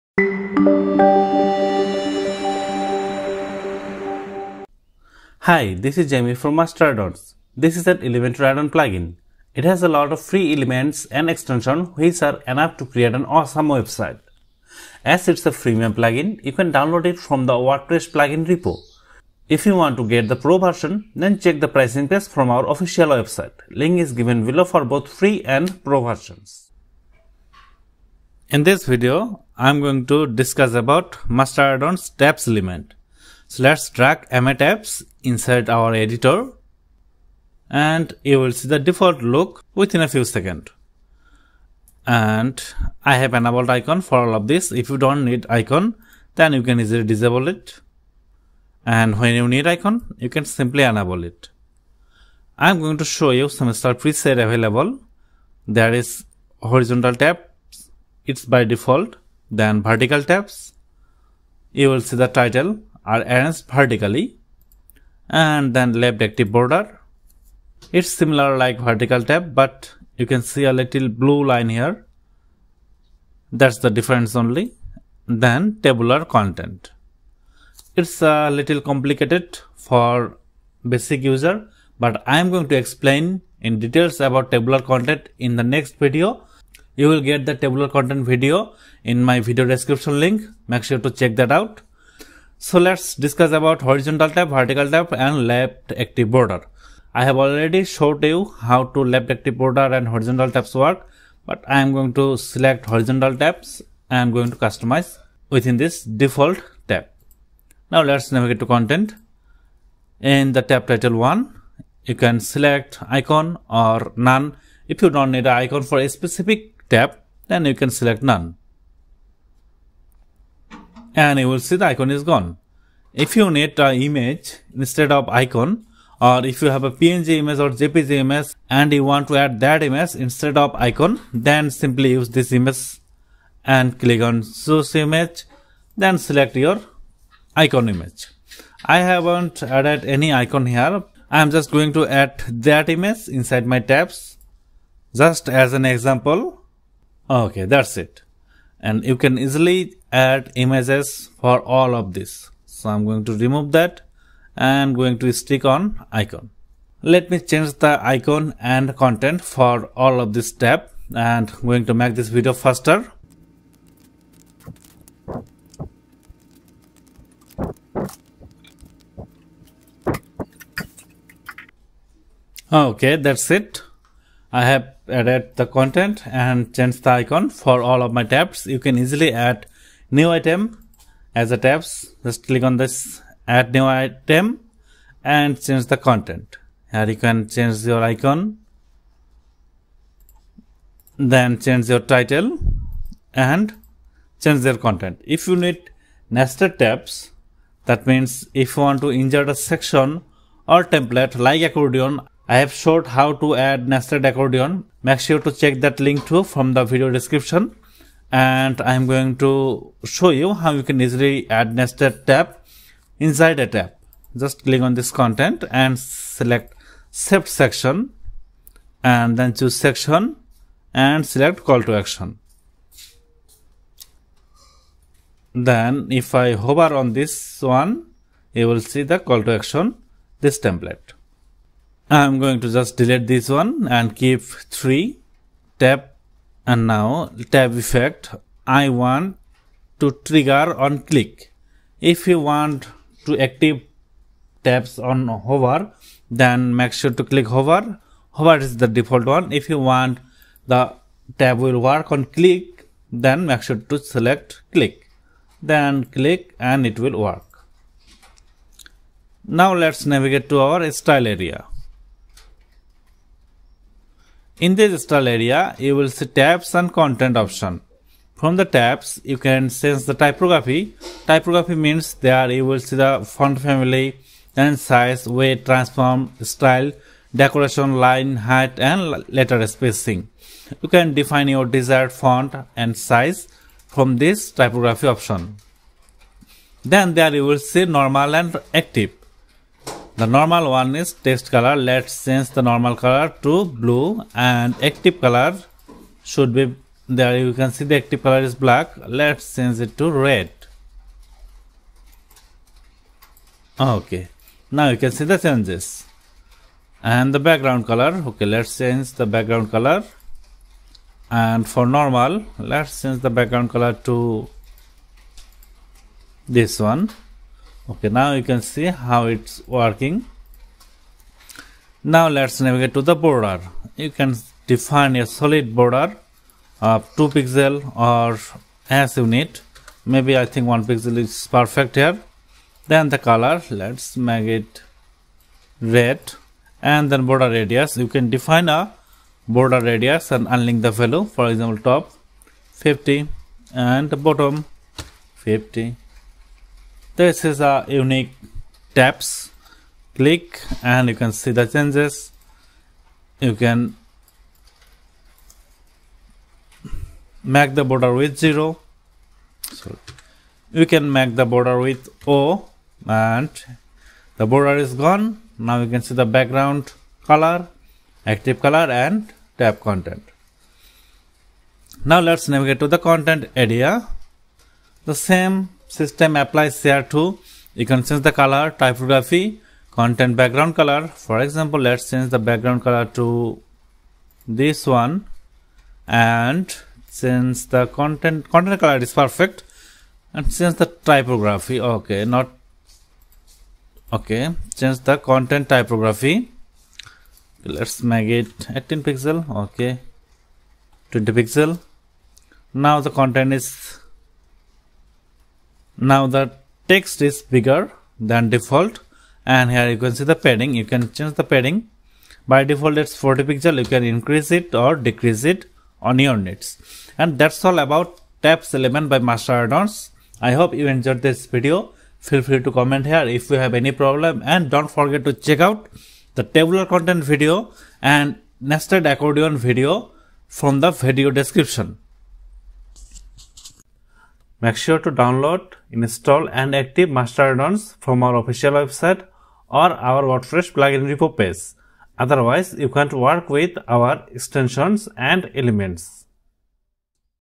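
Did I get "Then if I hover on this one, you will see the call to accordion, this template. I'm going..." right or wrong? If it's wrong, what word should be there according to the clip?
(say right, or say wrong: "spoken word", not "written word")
wrong: "action", not "accordion".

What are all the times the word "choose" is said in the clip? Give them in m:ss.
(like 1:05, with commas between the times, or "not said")
2:14, 3:39.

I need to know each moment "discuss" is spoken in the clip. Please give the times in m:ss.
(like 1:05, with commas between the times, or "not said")
0:30, 1:33.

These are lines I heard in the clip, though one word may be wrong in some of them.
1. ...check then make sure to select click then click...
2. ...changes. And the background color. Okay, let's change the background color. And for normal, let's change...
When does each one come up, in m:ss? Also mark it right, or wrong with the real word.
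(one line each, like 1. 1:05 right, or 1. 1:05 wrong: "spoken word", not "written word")
1. 4:12 wrong: "click", not "check"
2. 5:05 right.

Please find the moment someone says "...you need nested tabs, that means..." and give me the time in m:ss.
3:15.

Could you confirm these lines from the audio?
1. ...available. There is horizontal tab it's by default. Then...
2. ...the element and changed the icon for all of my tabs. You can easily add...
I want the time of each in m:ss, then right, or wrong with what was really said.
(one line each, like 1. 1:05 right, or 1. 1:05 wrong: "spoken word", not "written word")
1. 0:54 right
2. 2:55 wrong: "content", not "element".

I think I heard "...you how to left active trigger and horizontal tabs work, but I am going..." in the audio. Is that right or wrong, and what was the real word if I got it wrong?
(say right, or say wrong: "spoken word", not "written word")
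wrong: "border", not "trigger".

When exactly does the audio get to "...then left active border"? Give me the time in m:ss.
1:05.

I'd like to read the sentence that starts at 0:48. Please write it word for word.
And when you need icon, you can simply enable it.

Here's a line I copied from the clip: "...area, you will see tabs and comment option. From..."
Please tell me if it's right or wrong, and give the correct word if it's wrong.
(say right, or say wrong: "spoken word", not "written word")
wrong: "content", not "comment".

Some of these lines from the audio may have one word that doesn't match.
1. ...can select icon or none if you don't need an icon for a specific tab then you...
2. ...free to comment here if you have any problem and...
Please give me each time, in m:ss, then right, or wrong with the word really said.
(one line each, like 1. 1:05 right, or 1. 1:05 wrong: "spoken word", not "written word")
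1. 1:52 right
2. 7:02 right.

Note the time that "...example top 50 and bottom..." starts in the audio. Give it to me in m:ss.
5:41.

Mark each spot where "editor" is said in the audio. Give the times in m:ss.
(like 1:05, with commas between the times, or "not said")
0:35.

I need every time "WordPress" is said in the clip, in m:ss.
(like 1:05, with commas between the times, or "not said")
0:17, 7:20.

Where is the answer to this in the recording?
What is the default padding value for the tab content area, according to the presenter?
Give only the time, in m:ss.
6:53.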